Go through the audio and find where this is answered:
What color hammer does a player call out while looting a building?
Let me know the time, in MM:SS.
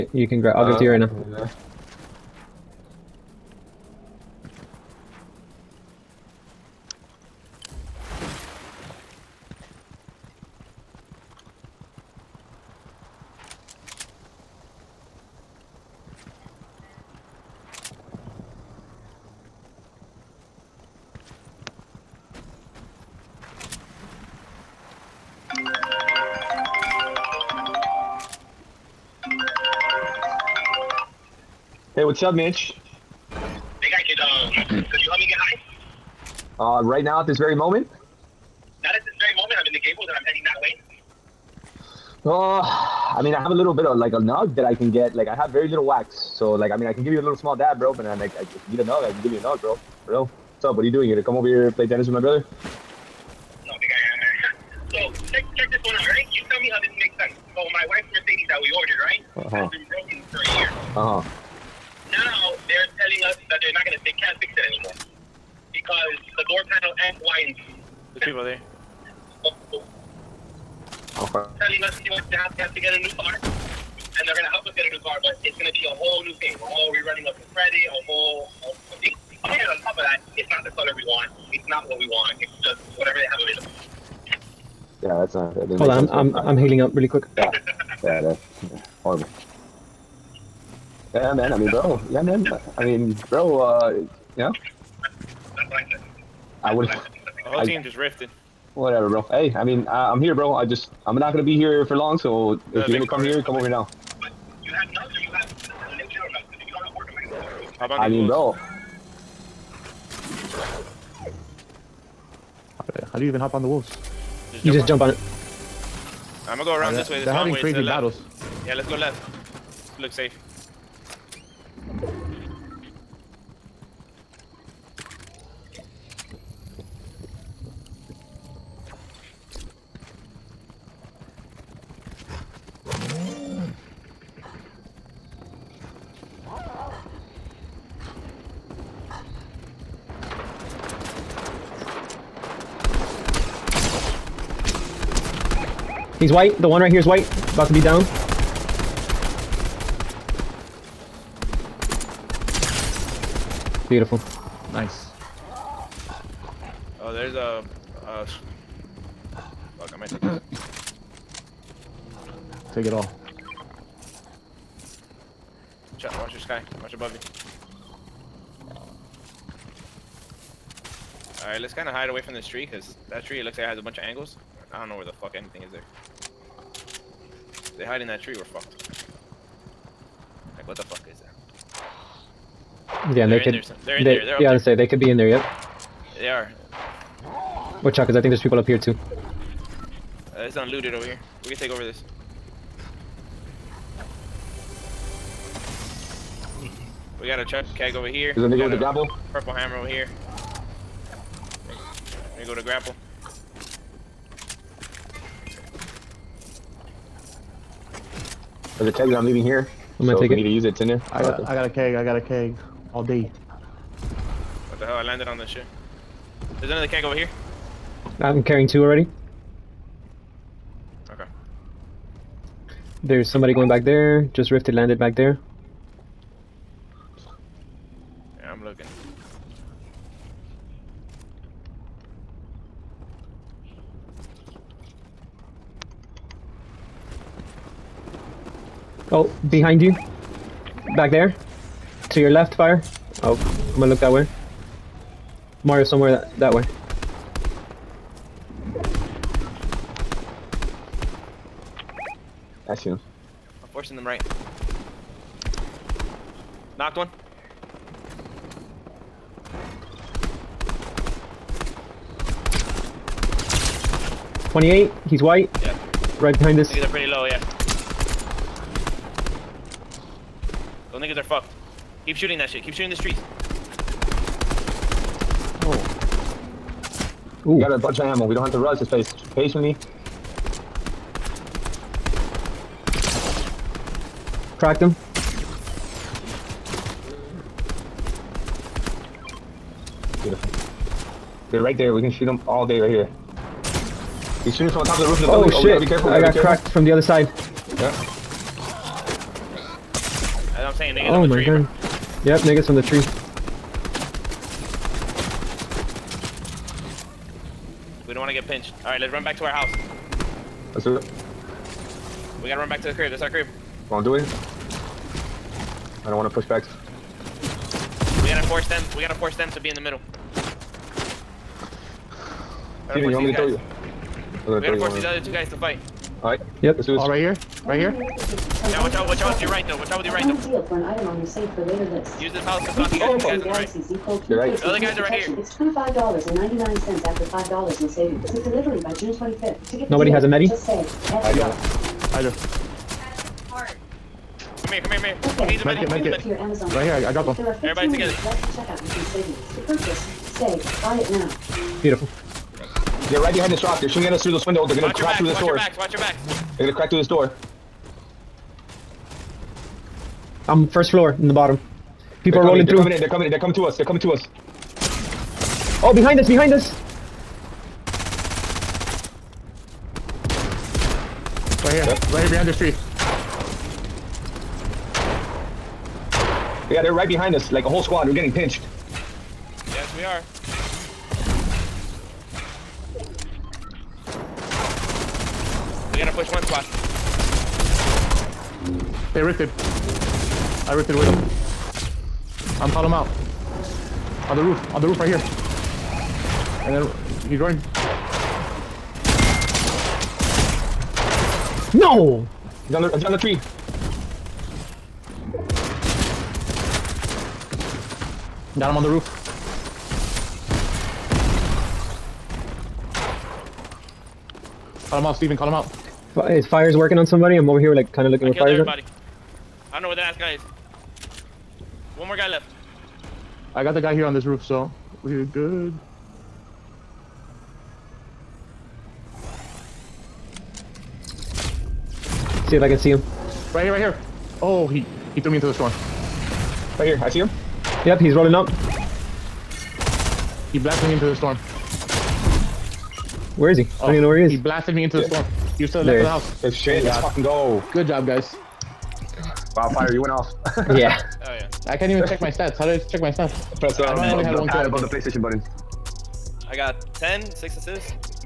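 03:19.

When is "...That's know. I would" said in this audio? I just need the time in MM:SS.
01:34.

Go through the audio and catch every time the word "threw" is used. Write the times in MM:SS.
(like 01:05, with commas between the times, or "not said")
07:15.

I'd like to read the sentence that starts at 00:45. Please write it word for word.
Like, I have very little wax, so like, I mean, I can give you a little small dab, bro.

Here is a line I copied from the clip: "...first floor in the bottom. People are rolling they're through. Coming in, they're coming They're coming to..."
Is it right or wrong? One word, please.
right.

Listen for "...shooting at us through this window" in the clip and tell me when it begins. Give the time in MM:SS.
05:53.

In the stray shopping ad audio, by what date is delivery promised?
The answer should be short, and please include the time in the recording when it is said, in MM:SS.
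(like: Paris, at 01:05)
June 25, at 05:38.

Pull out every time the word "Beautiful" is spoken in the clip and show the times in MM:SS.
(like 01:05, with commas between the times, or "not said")
02:33, 04:50, 05:51.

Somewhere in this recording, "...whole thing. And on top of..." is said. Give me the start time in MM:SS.
01:18.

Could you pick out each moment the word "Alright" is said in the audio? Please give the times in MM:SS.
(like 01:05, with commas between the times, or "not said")
02:51, 05:08, 05:26.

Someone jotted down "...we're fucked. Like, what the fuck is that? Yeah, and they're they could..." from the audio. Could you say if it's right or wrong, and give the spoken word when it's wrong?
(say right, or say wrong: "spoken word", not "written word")
right.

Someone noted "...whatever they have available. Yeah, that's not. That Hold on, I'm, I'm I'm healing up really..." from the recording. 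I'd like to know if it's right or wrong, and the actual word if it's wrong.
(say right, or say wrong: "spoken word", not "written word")
right.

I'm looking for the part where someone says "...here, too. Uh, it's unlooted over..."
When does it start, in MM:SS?
03:08.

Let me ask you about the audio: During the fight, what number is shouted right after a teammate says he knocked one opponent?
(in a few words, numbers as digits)
28.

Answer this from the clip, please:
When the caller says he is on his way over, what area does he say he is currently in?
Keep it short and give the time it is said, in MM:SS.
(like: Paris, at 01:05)
the Gables, at 00:39.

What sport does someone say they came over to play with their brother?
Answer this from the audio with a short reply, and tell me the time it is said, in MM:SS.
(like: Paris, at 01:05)
tennis, at 00:51.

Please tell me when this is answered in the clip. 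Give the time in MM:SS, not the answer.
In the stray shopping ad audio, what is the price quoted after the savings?
05:35.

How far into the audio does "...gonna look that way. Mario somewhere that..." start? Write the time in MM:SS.
04:03.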